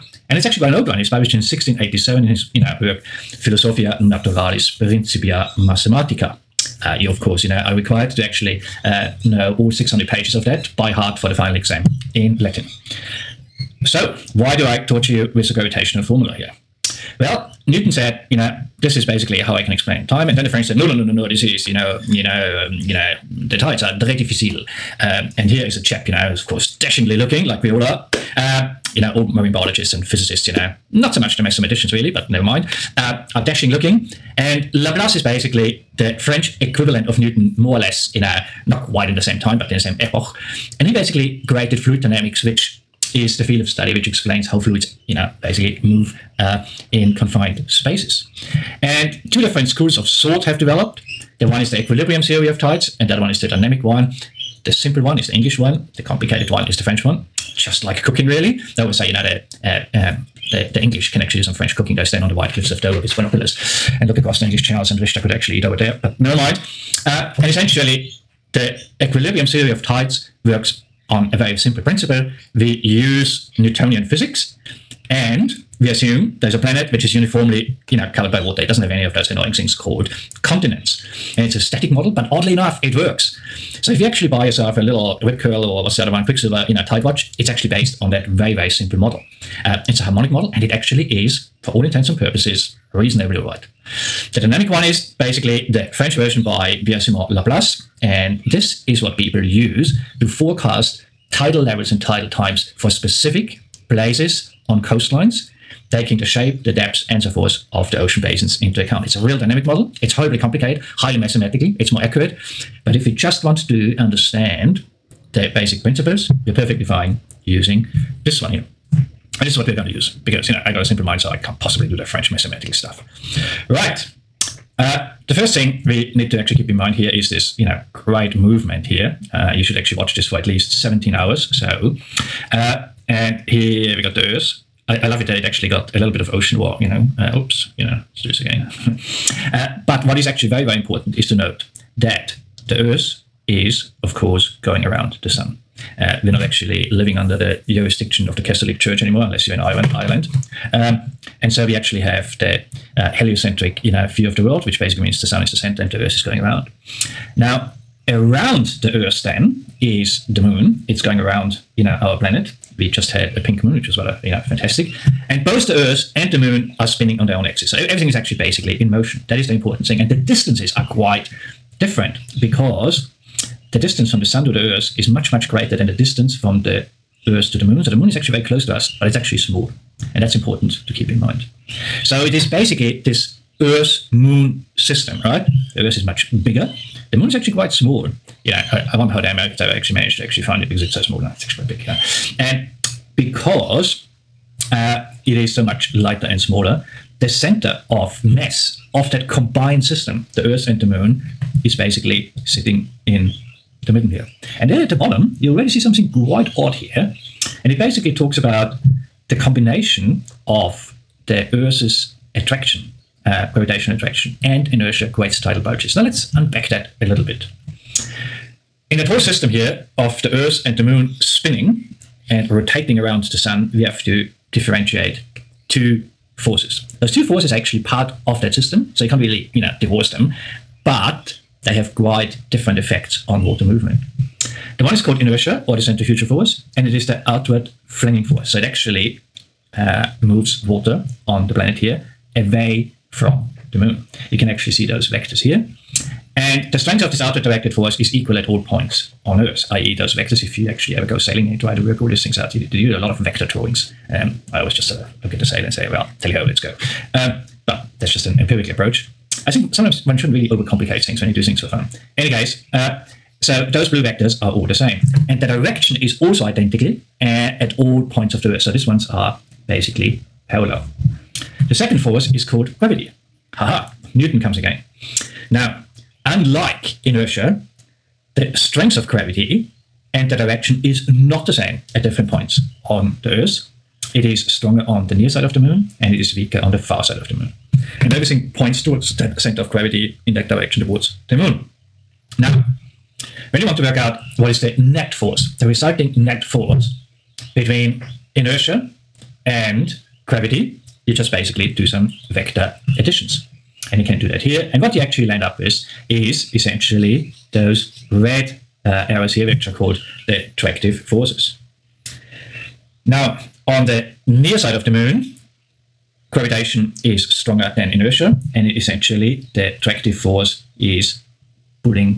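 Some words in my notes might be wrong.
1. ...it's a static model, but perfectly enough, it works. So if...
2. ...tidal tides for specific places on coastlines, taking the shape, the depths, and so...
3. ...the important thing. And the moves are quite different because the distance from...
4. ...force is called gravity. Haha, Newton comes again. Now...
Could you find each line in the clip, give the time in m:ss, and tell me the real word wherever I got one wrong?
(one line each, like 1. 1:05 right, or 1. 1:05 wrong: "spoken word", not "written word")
1. 1:21 wrong: "oddly", not "perfectly"
2. 1:42 wrong: "times", not "tides"
3. 2:49 wrong: "distances", not "moves"
4. 4:31 right.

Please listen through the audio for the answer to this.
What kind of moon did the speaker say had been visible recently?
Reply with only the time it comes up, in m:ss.
2:43.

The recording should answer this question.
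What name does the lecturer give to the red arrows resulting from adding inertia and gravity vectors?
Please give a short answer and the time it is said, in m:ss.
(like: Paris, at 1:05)
attractive forces, at 5:10.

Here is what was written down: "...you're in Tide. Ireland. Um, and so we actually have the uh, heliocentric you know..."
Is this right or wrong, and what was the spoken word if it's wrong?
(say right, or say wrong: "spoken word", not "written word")
wrong: "Ireland", not "Tide".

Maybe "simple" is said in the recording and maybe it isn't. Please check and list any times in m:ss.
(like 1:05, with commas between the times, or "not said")
0:54, 1:11, 1:28, 2:00.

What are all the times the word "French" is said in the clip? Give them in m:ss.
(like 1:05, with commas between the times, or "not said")
0:20, 0:36, 0:56, 1:01, 1:35, 2:02.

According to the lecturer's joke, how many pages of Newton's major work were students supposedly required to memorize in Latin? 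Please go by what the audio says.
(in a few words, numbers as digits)
600.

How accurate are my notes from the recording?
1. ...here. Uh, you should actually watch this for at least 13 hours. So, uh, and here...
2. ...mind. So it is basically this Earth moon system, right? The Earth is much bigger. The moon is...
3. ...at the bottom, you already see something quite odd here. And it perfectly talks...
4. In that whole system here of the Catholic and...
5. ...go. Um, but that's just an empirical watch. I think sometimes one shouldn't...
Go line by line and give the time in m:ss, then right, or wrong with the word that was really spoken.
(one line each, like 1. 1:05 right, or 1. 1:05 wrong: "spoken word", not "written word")
1. 2:08 wrong: "17", not "13"
2. 3:01 right
3. 3:24 wrong: "basically", not "perfectly"
4. 3:38 wrong: "Earth", not "Catholic"
5. 4:16 wrong: "approach", not "watch".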